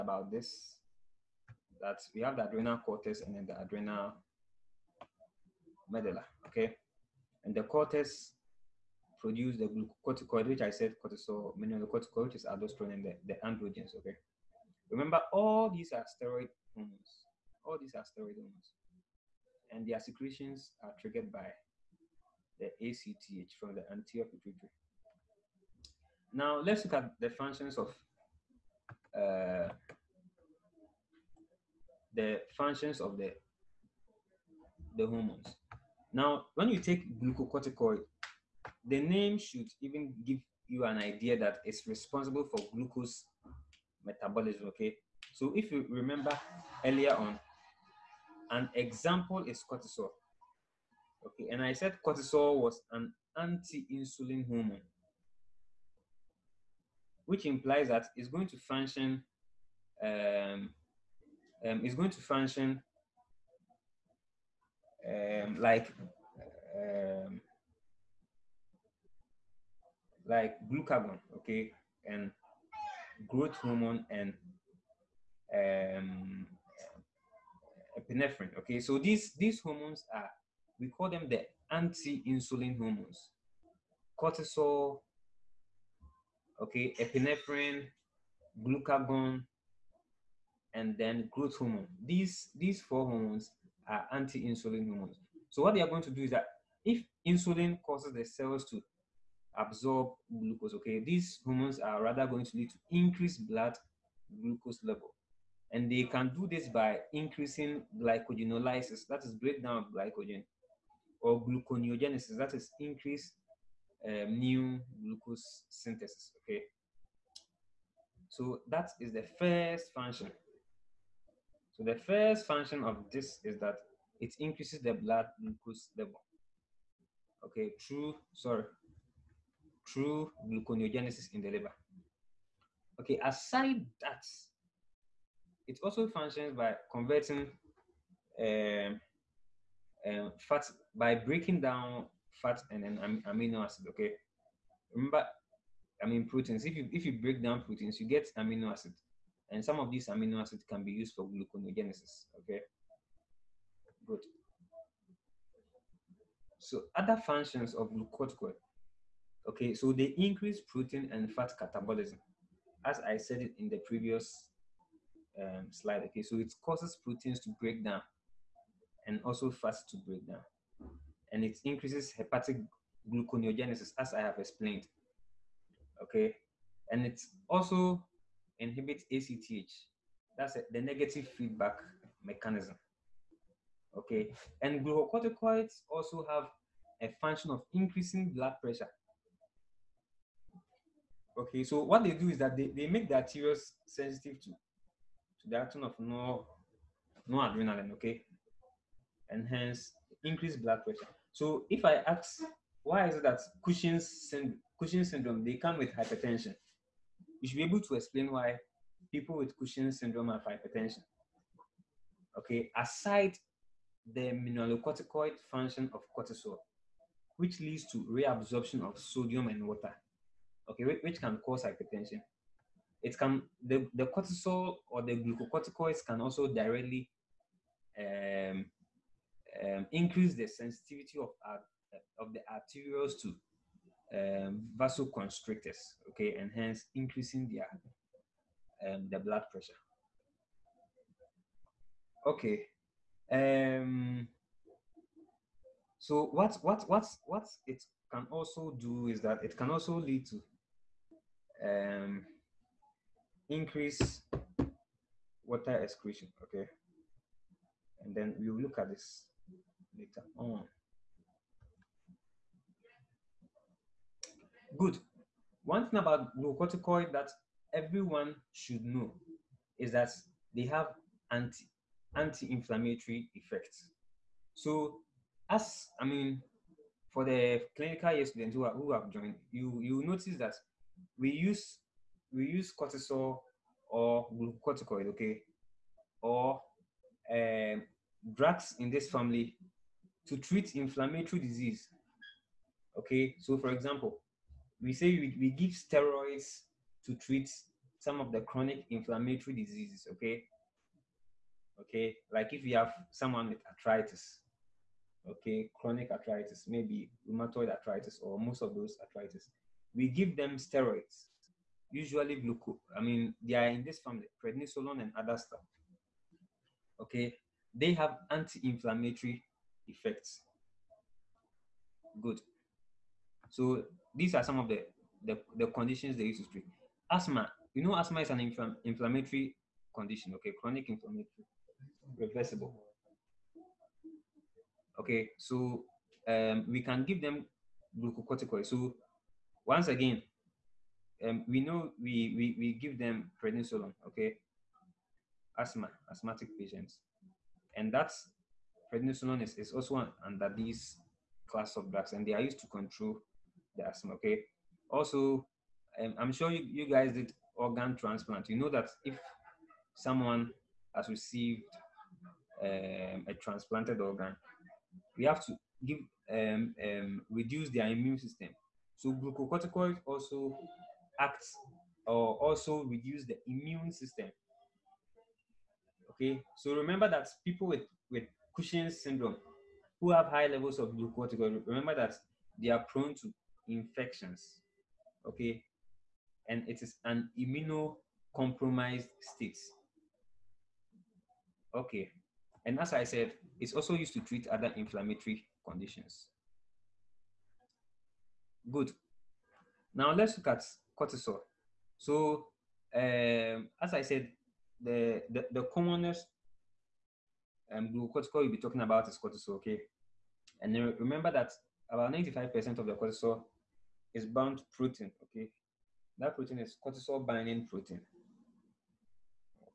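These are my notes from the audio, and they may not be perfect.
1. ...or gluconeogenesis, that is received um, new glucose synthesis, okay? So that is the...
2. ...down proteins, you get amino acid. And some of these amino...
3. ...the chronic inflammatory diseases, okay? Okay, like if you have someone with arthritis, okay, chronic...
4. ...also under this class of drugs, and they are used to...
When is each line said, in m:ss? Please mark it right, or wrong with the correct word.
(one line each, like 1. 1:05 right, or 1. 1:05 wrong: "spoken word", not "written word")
1. 1:51 wrong: "increased", not "received"
2. 2:27 right
3. 4:58 right
4. 5:49 right.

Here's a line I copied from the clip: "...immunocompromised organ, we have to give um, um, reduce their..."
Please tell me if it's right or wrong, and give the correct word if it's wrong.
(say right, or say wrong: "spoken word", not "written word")
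wrong: "transplanted", not "immunocompromised".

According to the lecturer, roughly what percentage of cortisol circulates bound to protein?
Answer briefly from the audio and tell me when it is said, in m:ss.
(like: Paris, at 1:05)
95%, at 6:52.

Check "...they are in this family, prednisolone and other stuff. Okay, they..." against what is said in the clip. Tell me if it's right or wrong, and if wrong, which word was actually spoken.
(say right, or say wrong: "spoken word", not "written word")
right.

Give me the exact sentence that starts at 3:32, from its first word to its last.
Okay, aside the mineralocorticoid function of cortisol, which leads to reabsorption of sodium and water, okay, which can cause hypertension.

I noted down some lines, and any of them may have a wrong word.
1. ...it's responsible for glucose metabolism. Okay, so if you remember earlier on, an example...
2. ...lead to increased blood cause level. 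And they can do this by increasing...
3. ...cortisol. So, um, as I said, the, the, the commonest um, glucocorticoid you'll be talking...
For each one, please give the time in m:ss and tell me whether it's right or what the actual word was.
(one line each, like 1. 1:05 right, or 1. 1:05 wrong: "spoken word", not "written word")
1. 0:41 right
2. 1:42 wrong: "glucose", not "cause"
3. 6:40 right.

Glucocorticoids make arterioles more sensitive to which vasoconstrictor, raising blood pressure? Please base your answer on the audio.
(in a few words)
noradrenaline.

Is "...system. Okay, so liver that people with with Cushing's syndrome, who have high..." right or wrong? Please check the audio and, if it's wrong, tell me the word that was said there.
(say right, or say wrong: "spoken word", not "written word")
wrong: "remember", not "liver".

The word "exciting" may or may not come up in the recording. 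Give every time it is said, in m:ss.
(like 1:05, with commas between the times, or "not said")
not said.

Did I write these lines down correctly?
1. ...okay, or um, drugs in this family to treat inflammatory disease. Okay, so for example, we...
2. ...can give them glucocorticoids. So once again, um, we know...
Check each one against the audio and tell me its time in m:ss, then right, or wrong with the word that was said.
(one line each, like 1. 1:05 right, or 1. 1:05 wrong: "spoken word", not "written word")
1. 4:45 right
2. 5:36 right.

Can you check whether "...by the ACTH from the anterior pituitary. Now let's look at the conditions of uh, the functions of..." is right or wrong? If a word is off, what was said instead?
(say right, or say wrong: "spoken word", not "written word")
wrong: "functions", not "conditions".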